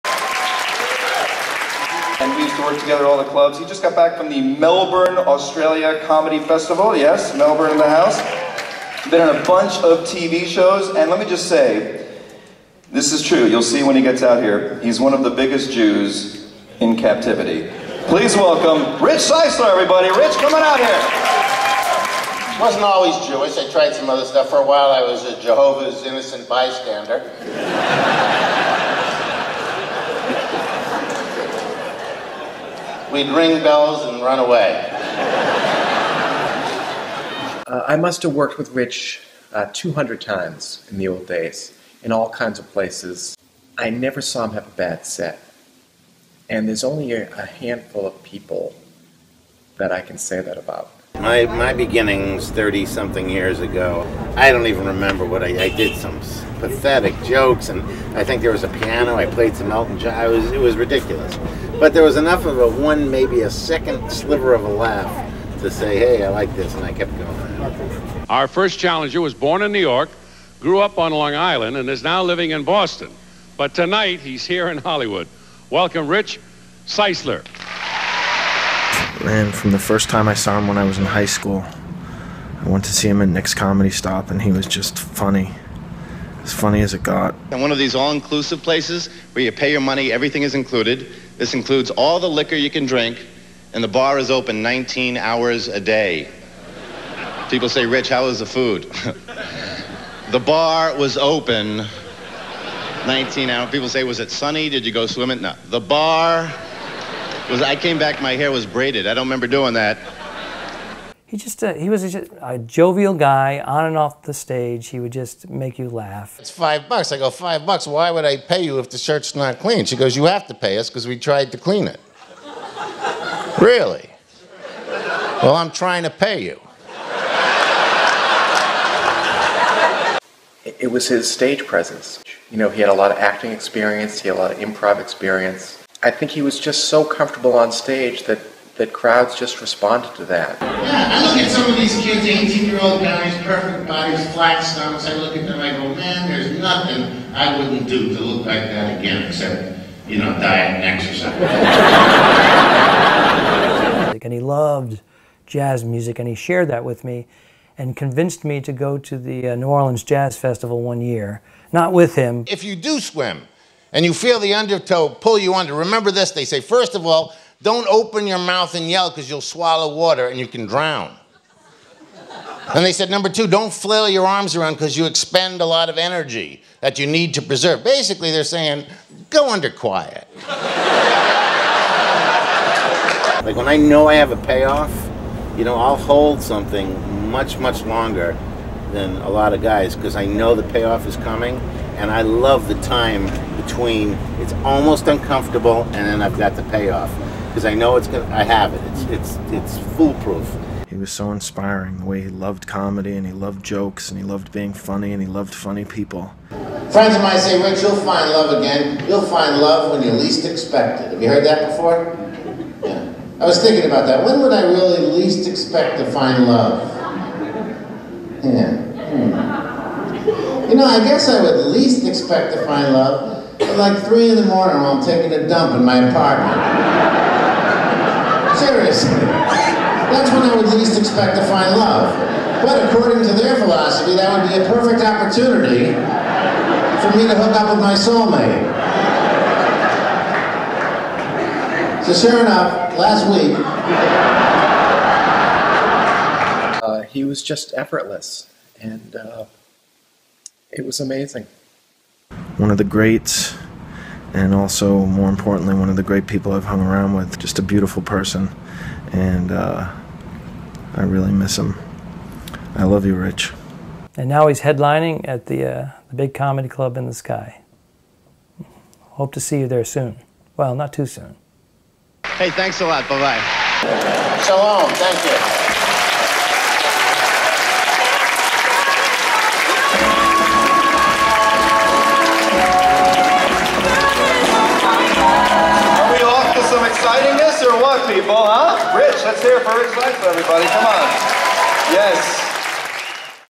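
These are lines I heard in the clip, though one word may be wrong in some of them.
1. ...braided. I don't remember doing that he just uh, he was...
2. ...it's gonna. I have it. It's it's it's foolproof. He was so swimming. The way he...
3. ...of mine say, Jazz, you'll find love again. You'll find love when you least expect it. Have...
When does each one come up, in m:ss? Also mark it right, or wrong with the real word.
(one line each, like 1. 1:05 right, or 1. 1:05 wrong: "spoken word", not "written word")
1. 1:48 right
2. 3:17 wrong: "inspiring", not "swimming"
3. 3:27 wrong: "Rich", not "Jazz".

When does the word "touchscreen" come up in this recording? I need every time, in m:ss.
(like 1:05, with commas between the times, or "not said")
not said.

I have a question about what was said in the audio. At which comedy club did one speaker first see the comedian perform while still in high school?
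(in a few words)
Nick's Comedy Stop.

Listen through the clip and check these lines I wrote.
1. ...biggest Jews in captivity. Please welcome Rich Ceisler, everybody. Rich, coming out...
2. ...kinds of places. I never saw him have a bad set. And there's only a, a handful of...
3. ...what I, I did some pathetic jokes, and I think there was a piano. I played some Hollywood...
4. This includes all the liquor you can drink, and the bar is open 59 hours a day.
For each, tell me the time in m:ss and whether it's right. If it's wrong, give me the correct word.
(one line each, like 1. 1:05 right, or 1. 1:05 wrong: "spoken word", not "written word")
1. 0:15 right
2. 0:42 right
3. 0:55 wrong: "Elton", not "Hollywood"
4. 1:31 wrong: "19", not "59".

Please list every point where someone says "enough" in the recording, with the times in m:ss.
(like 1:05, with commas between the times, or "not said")
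1:02, 4:02.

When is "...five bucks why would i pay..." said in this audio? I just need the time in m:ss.
1:57.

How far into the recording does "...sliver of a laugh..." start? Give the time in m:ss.
1:04.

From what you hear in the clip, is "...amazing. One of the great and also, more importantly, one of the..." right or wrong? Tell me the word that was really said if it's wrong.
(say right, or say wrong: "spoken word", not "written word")
right.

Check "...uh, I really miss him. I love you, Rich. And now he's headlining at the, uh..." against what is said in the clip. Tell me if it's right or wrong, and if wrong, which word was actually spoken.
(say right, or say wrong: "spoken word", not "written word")
right.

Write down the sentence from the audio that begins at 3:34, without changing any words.
When would I really least expect to find love?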